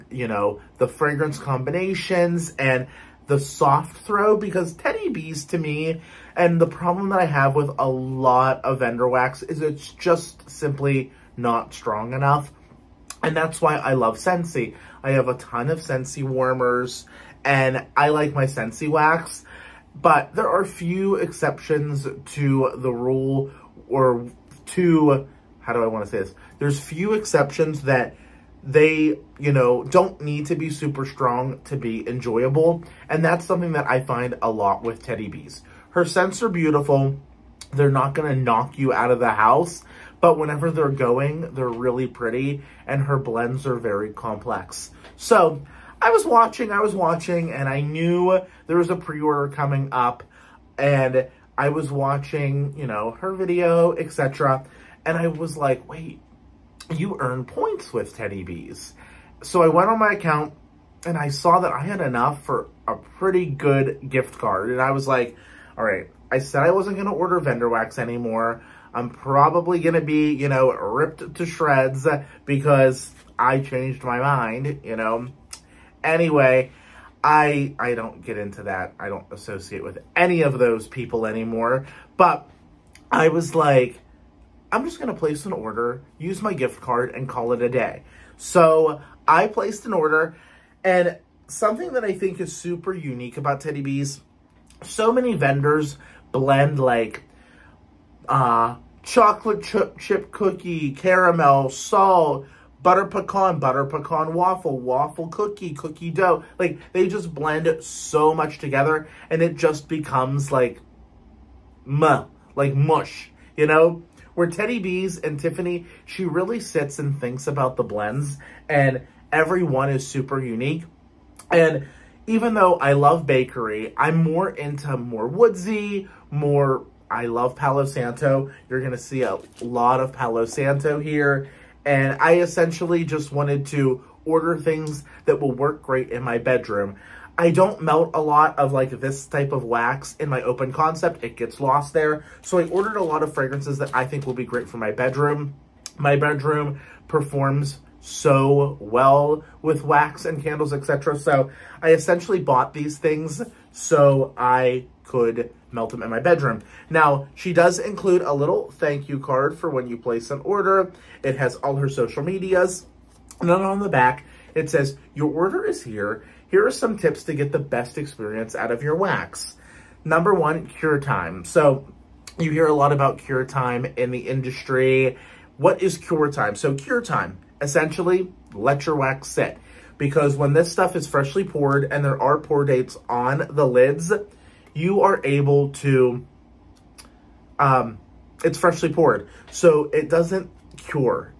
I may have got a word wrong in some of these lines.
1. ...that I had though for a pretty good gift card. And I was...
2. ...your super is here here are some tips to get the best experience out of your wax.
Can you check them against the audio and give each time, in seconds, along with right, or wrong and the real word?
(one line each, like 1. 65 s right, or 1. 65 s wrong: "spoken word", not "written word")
1. 61 s wrong: "enough", not "though"
2. 165 s wrong: "order", not "super".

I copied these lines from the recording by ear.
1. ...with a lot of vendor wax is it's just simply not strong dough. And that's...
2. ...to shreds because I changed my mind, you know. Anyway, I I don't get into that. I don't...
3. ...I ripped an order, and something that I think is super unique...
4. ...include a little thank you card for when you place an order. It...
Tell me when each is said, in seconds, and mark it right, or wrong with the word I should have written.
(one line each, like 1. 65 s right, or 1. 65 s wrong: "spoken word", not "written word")
1. 7 s wrong: "enough", not "dough"
2. 71 s right
3. 89 s wrong: "placed", not "ripped"
4. 157 s right.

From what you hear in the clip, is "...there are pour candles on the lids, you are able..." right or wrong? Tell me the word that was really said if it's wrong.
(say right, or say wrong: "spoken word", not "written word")
wrong: "dates", not "candles".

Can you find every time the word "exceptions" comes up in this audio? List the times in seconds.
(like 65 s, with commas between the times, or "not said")
21 s, 27 s.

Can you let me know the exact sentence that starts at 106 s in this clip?
Like, they just blend it so much together, and it just becomes like, muh, like mush, you know?